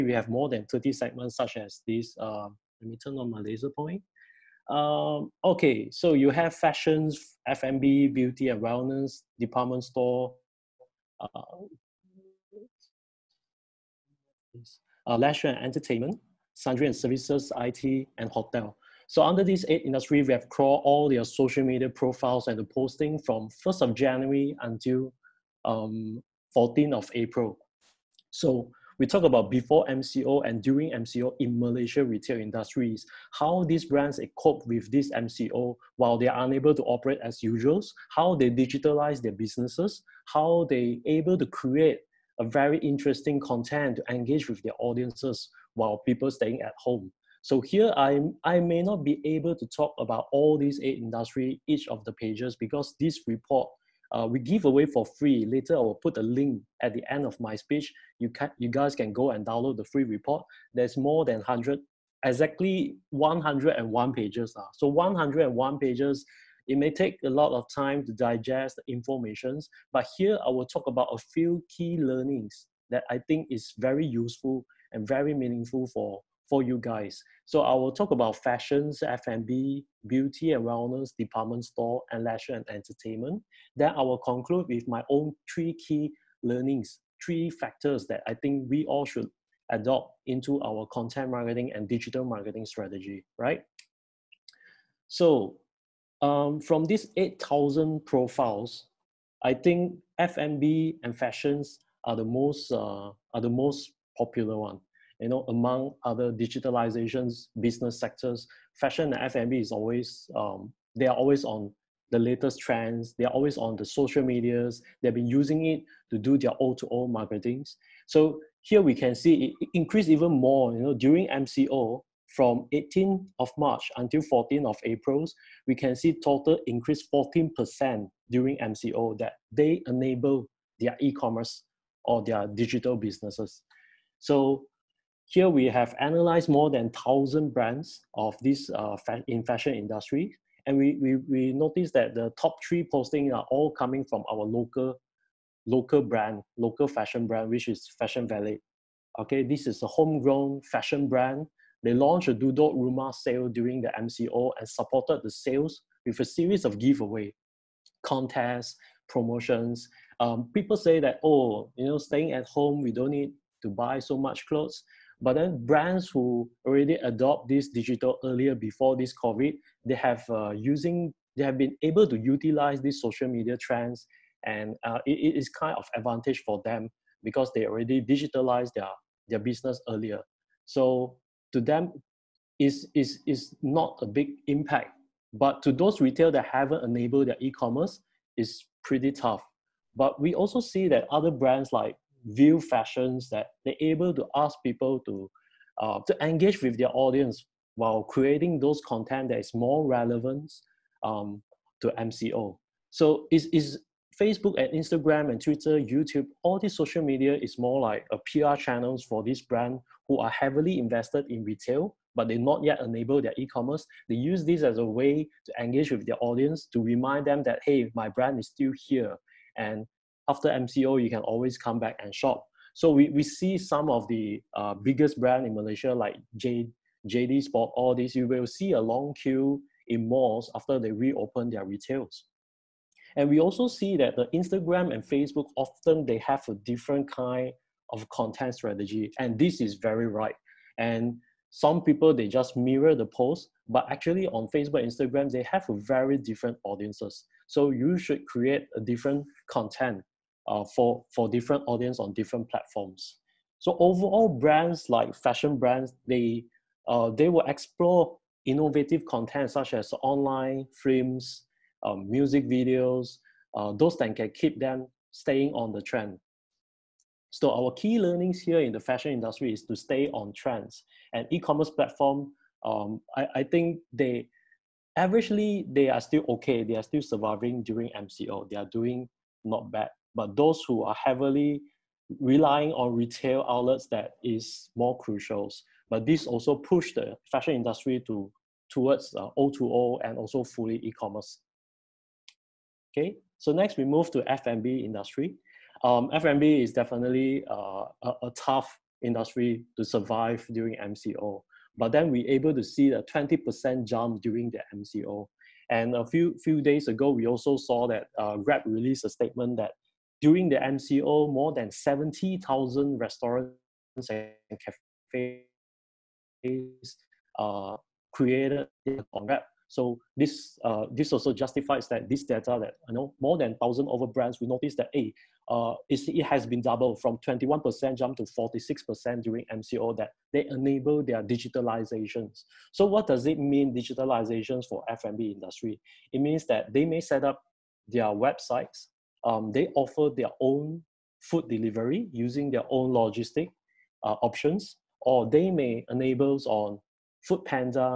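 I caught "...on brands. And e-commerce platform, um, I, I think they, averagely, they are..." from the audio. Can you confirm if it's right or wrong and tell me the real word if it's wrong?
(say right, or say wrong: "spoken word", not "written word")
wrong: "trends", not "brands".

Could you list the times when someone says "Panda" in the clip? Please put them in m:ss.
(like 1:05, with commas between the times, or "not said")
5:47.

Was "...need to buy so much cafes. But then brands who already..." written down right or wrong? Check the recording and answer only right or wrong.
wrong.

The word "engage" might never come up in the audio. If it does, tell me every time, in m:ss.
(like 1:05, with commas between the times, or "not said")
0:44, 3:16, 3:35.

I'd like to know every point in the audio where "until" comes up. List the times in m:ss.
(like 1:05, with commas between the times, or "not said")
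0:24, 2:03.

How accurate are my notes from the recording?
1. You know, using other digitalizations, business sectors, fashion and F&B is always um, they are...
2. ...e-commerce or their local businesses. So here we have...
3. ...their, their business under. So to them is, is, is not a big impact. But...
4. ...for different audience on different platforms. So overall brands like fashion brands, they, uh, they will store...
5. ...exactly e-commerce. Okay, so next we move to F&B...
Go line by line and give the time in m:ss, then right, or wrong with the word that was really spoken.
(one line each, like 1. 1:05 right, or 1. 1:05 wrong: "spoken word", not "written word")
1. 1:45 wrong: "among", not "using"
2. 2:10 wrong: "digital", not "local"
3. 2:58 wrong: "earlier", not "under"
4. 4:11 wrong: "explore", not "store"
5. 4:50 wrong: "fully", not "exactly".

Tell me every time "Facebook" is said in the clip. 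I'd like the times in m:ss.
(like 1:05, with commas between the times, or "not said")
3:24, 3:55, 4:04.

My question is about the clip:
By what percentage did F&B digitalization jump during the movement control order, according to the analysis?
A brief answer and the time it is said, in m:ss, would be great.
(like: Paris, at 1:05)
20%, at 5:03.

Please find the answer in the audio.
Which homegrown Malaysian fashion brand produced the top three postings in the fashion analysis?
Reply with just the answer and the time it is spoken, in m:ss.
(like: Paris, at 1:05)
Fashion Valley, at 2:27.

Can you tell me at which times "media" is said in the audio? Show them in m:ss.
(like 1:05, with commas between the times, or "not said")
0:21, 1:54, 2:53, 3:27.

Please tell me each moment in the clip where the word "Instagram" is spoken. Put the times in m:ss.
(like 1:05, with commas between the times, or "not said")
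3:24, 3:54, 4:04.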